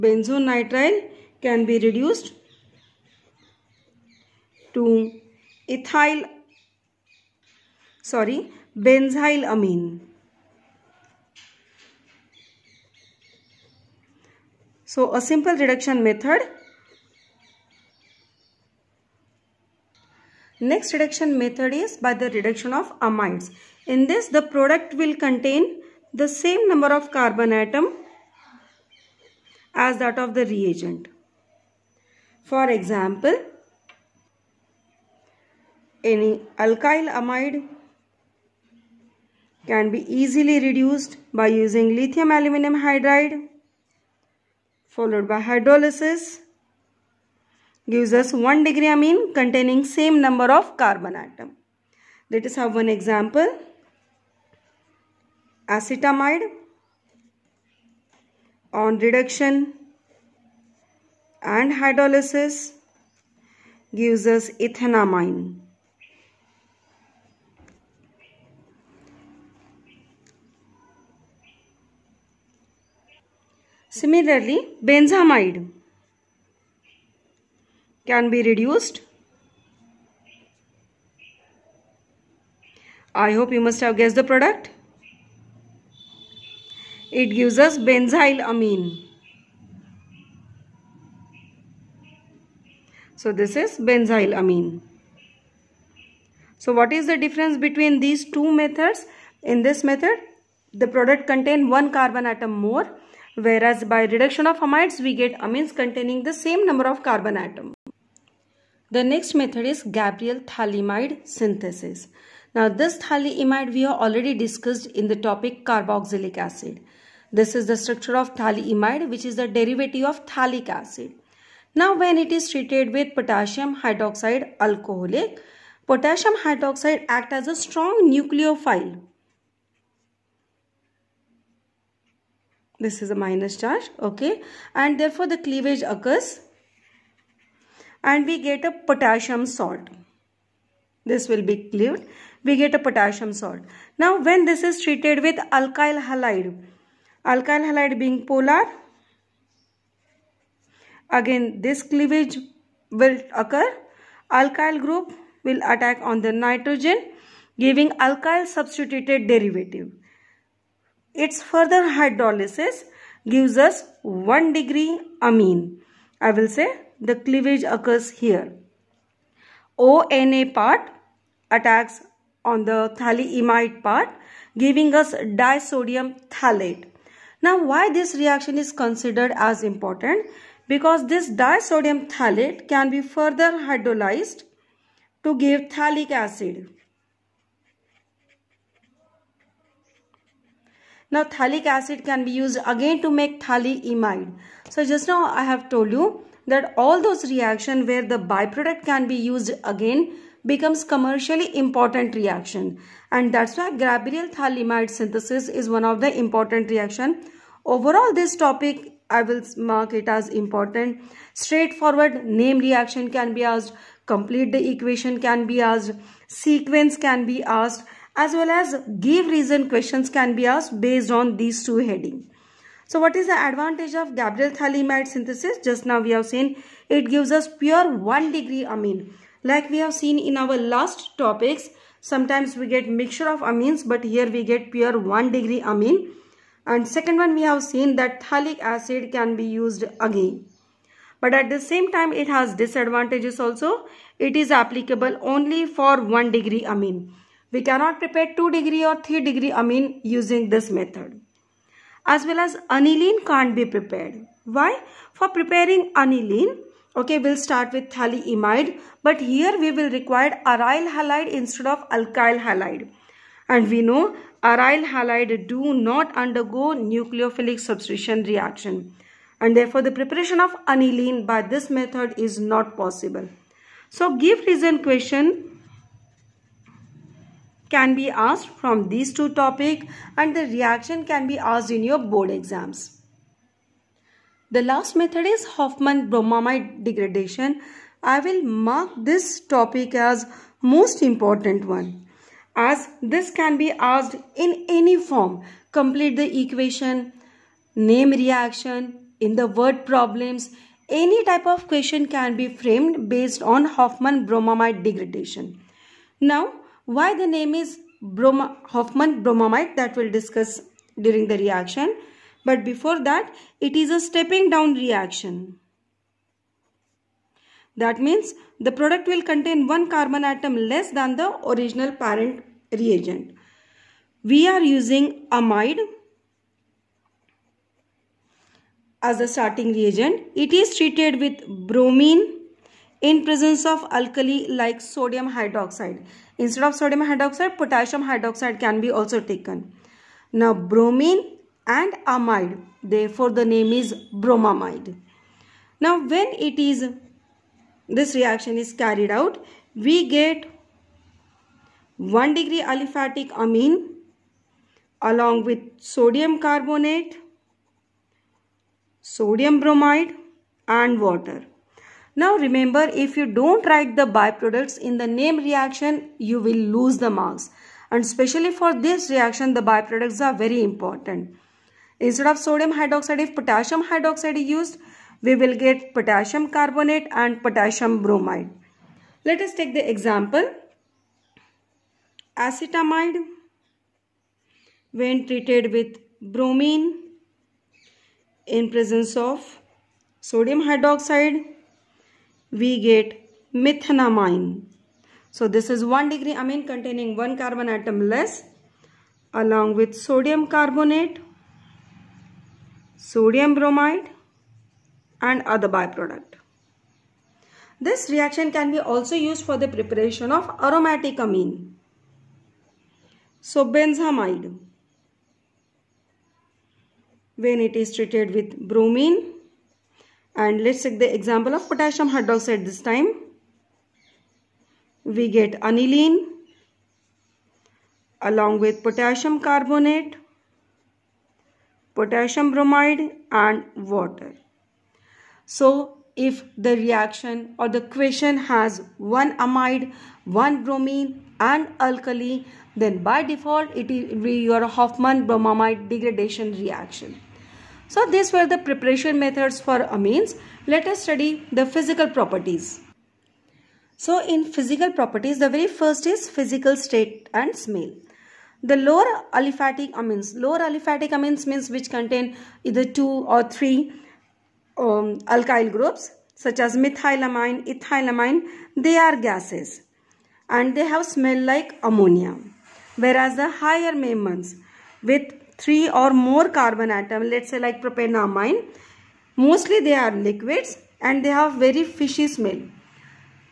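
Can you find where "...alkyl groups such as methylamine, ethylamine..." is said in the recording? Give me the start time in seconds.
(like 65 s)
465 s.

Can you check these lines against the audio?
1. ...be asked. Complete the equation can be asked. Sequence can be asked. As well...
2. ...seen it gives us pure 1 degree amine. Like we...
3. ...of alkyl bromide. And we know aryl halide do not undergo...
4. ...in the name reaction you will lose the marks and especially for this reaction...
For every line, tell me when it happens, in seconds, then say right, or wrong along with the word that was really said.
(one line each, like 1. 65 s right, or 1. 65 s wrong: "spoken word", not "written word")
1. 213 s right
2. 226 s right
3. 261 s wrong: "halide", not "bromide"
4. 364 s right.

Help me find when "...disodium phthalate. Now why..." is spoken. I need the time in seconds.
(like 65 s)
175 s.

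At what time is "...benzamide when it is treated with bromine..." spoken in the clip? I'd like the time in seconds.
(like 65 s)
413 s.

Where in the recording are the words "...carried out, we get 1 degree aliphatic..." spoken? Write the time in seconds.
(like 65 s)
348 s.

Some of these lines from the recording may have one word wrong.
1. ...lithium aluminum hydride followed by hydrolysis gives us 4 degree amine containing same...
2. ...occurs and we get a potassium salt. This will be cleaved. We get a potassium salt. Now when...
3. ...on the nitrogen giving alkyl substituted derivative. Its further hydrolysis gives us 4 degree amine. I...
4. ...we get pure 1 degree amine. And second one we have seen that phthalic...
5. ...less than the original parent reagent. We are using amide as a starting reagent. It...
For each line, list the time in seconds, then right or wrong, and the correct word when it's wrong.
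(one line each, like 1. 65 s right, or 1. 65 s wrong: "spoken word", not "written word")
1. 41 s wrong: "1", not "4"
2. 135 s right
3. 156 s wrong: "1", not "4"
4. 234 s right
5. 320 s right.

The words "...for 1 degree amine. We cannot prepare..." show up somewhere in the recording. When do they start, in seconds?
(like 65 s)
245 s.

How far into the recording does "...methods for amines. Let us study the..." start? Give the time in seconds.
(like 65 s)
449 s.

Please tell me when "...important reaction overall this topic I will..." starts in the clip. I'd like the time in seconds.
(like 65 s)
206 s.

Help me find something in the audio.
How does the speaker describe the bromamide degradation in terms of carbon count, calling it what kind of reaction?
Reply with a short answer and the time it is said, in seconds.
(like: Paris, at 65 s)
Stepping down reaction, at 313 s.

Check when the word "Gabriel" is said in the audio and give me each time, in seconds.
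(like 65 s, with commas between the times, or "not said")
109 s, 203 s, 224 s.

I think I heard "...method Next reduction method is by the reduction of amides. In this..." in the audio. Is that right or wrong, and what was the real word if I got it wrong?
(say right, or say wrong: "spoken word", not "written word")
right.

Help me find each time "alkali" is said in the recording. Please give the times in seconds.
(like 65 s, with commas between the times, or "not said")
333 s, 441 s.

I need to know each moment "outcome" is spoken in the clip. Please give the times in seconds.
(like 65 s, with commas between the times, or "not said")
not said.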